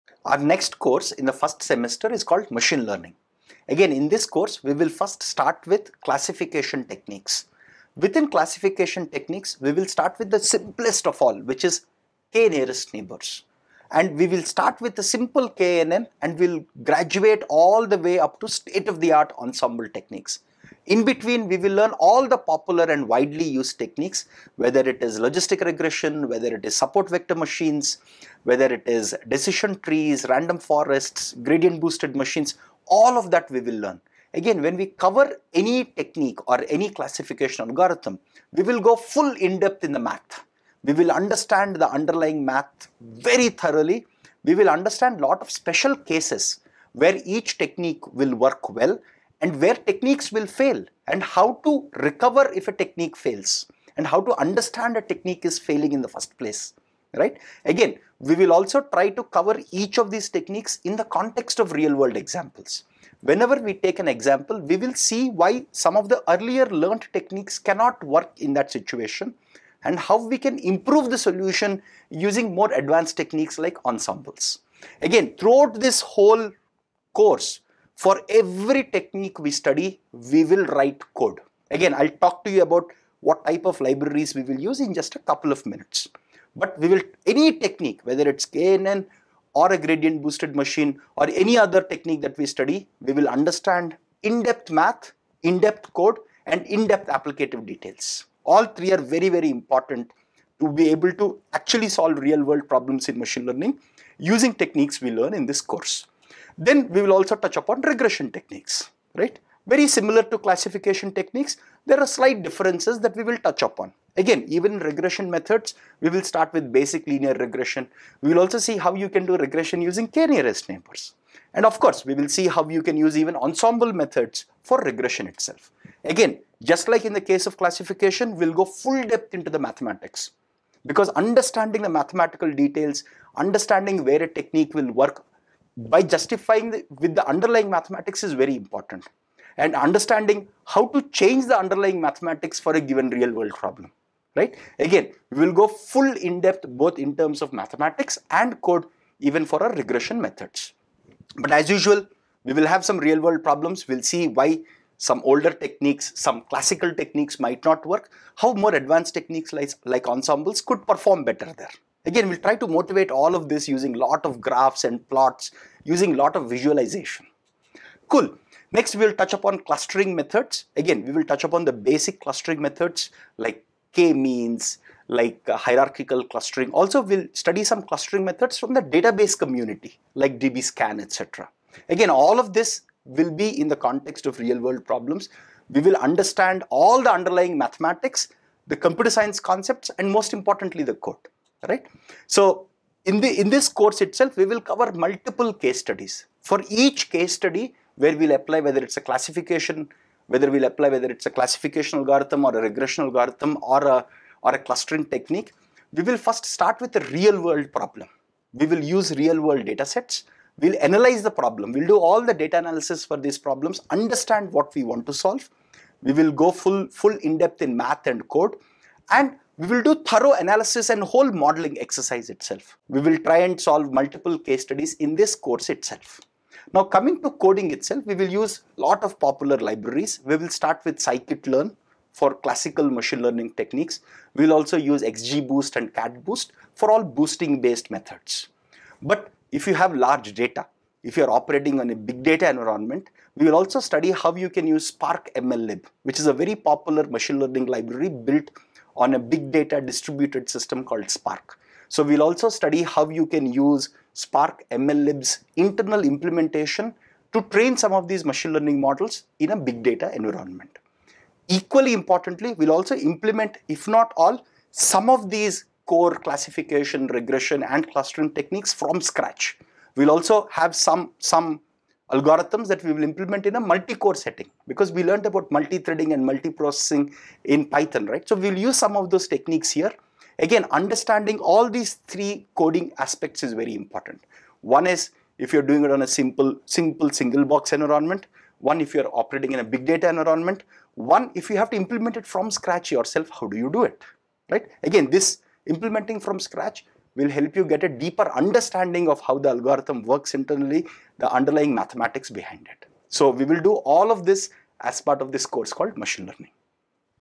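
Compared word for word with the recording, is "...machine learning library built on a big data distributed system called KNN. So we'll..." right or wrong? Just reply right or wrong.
wrong.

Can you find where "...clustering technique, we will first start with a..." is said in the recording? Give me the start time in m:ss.
3:24.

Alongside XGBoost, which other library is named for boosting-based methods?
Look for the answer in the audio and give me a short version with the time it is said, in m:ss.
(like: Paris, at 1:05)
CatBoost, at 3:55.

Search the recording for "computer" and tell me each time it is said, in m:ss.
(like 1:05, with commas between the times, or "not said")
3:08.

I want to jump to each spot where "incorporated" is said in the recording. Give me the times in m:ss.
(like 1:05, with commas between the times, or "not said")
not said.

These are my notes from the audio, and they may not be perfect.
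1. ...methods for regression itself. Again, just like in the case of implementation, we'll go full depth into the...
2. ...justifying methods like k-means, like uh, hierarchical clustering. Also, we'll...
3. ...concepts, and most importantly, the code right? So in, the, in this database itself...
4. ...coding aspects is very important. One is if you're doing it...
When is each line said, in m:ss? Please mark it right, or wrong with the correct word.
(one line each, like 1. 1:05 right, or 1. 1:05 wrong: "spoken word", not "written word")
1. 2:03 wrong: "classification", not "implementation"
2. 2:52 wrong: "clustering", not "justifying"
3. 3:09 wrong: "course", not "database"
4. 4:42 right.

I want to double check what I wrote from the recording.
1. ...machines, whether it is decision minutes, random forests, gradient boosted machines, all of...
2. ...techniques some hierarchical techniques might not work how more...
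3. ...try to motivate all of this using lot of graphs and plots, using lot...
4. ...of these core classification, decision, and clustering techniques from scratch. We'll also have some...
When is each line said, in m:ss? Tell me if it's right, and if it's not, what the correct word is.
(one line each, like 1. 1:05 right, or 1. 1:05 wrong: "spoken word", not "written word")
1. 0:27 wrong: "trees", not "minutes"
2. 2:35 wrong: "classical", not "hierarchical"
3. 2:42 right
4. 4:25 wrong: "regression", not "decision".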